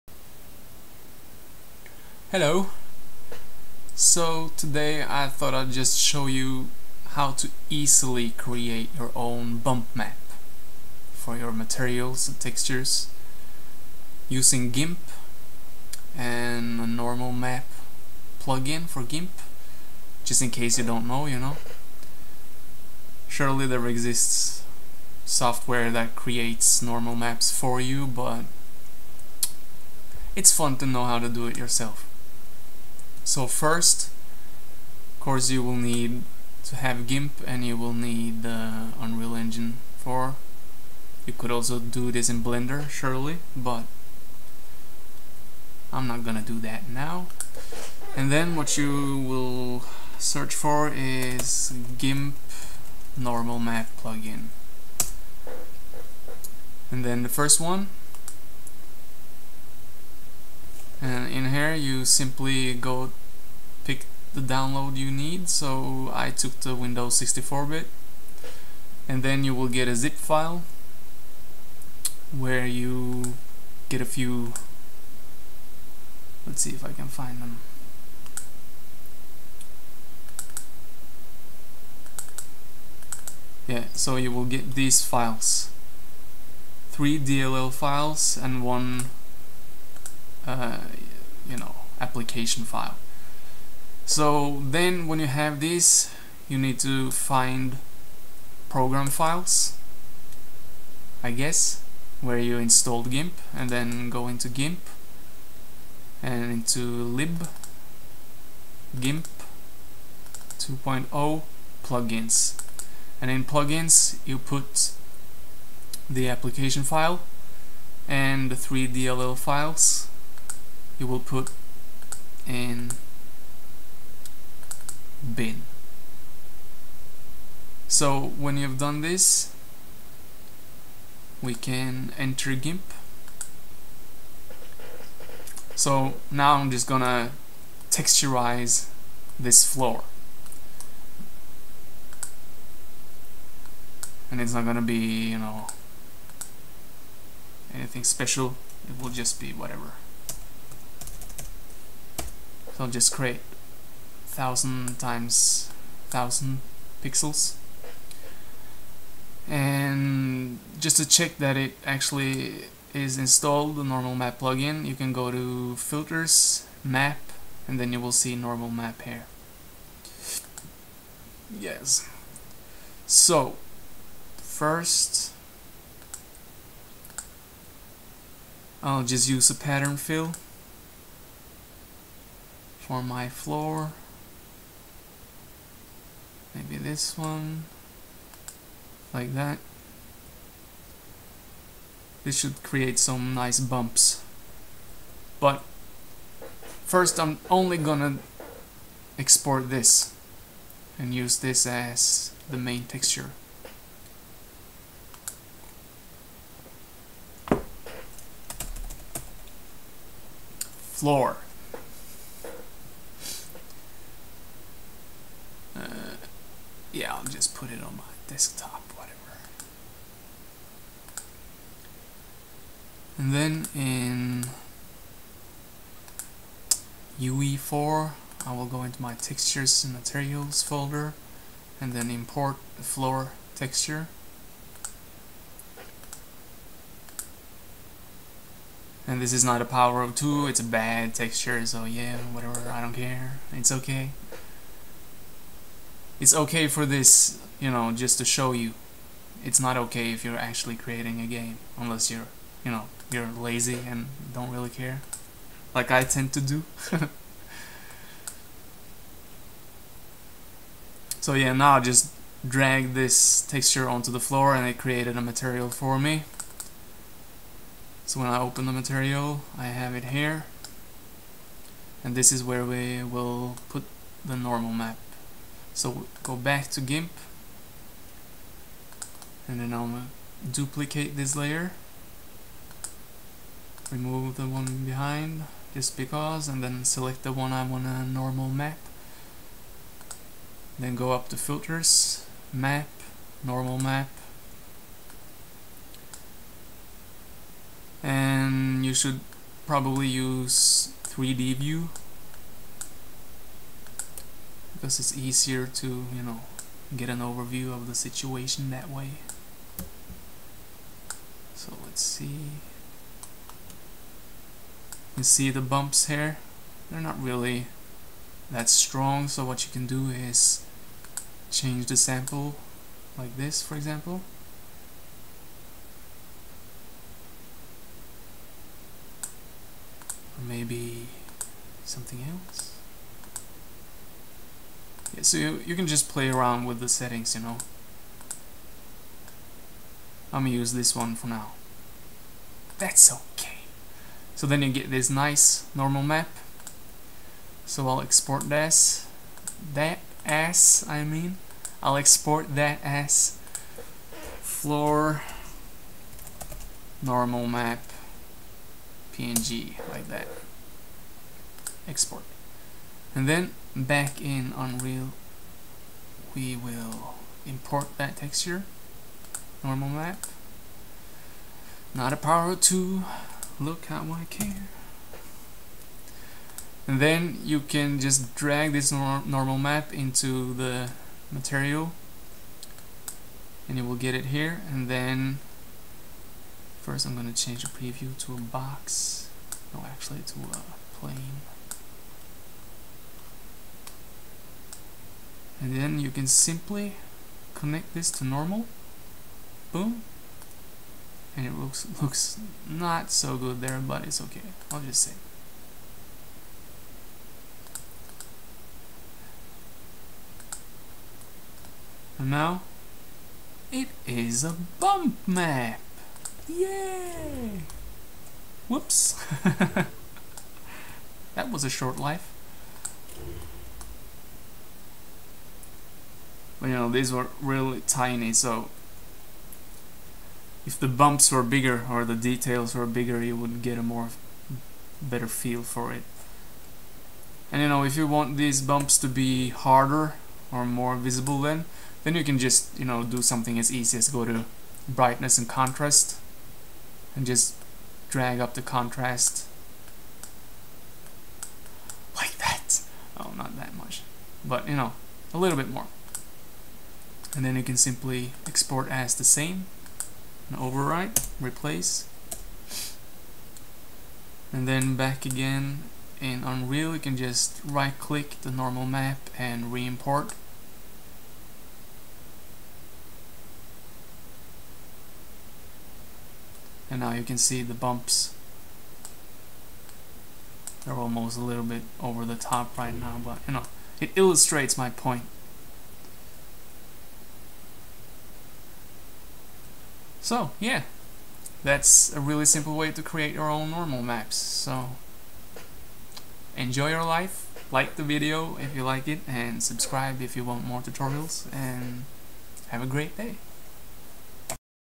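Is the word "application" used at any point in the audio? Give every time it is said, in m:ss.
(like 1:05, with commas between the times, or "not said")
1:31, 1:56.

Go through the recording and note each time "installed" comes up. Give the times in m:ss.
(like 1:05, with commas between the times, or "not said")
1:42, 2:43.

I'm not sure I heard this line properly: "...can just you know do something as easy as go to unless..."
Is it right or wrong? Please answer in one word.
wrong.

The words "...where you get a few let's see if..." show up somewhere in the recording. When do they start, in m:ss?
1:12.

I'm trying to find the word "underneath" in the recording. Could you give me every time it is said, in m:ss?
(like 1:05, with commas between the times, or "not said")
not said.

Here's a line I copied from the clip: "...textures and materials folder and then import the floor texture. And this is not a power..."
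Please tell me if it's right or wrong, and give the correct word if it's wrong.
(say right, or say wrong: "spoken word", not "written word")
right.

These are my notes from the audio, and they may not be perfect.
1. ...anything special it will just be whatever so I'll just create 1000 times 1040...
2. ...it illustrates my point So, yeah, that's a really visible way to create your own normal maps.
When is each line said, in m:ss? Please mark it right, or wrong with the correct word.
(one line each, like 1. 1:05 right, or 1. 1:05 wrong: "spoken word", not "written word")
1. 2:27 wrong: "1000", not "1040"
2. 8:04 wrong: "simple", not "visible".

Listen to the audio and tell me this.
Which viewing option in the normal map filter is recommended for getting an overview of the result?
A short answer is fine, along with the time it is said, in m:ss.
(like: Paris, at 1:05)
3D view, at 5:01.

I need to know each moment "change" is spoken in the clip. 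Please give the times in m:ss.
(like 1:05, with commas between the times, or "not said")
5:21, 6:27.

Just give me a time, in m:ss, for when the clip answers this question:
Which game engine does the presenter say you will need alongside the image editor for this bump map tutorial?
0:38.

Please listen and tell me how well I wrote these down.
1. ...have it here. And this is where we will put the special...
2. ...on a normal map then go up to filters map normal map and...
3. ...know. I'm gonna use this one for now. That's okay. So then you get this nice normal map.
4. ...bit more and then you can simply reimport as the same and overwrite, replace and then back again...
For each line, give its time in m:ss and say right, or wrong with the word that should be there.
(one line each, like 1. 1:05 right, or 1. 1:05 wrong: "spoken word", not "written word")
1. 4:29 wrong: "normal", not "special"
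2. 4:47 right
3. 5:37 right
4. 7:35 wrong: "export", not "reimport".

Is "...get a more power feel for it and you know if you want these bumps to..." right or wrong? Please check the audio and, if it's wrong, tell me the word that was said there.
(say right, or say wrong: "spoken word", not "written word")
wrong: "better", not "power".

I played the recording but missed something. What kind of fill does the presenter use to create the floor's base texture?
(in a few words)
pattern fill.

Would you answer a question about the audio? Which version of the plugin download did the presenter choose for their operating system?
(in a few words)
Windows 64-bit.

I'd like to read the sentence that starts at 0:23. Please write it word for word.
Surely there exists software that creates normal maps for you, but it's fun to know how to do it yourself.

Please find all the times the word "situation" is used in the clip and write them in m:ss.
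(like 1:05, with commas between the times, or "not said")
5:07.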